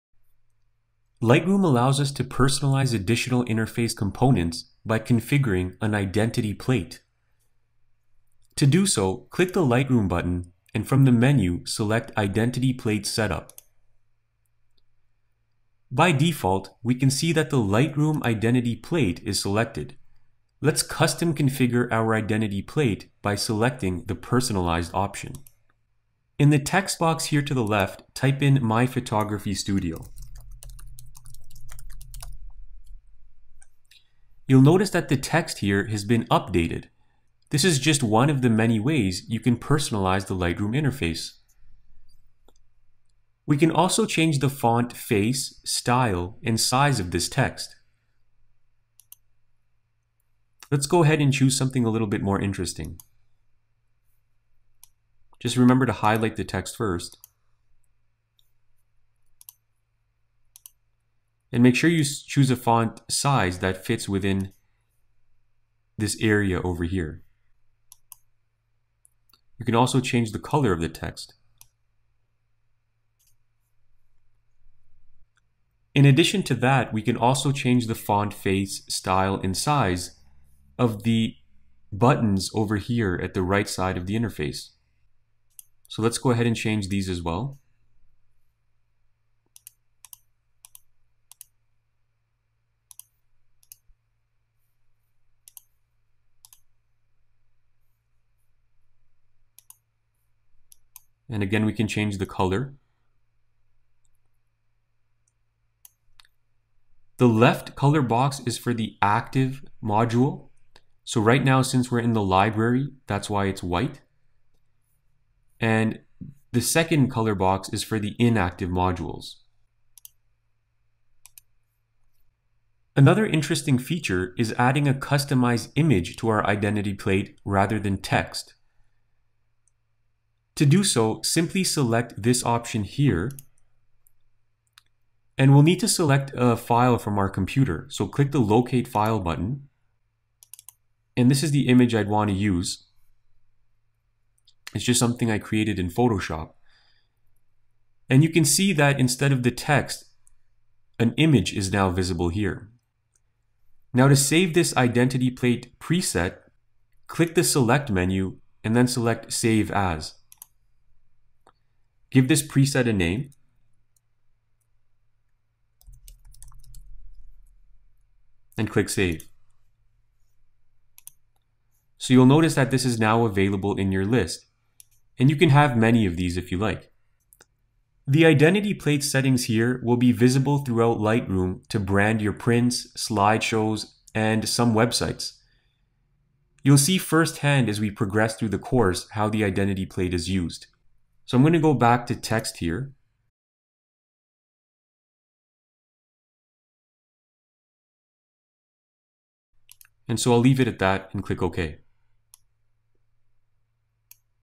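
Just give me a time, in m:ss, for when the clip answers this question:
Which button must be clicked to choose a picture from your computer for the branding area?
2:18.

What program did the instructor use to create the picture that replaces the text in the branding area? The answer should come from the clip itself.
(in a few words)
Photoshop.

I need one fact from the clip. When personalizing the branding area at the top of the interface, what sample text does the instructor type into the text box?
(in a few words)
My Photography Studio.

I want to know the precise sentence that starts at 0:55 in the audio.
Just remember to highlight the text first.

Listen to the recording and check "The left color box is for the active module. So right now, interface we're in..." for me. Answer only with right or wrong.
wrong.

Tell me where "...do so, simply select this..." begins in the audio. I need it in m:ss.
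2:10.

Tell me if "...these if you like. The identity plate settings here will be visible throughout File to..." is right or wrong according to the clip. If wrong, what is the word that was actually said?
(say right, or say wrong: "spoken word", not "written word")
wrong: "Lightroom", not "File".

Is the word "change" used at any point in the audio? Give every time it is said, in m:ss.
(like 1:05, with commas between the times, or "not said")
0:44, 1:09, 1:17, 1:26, 1:41.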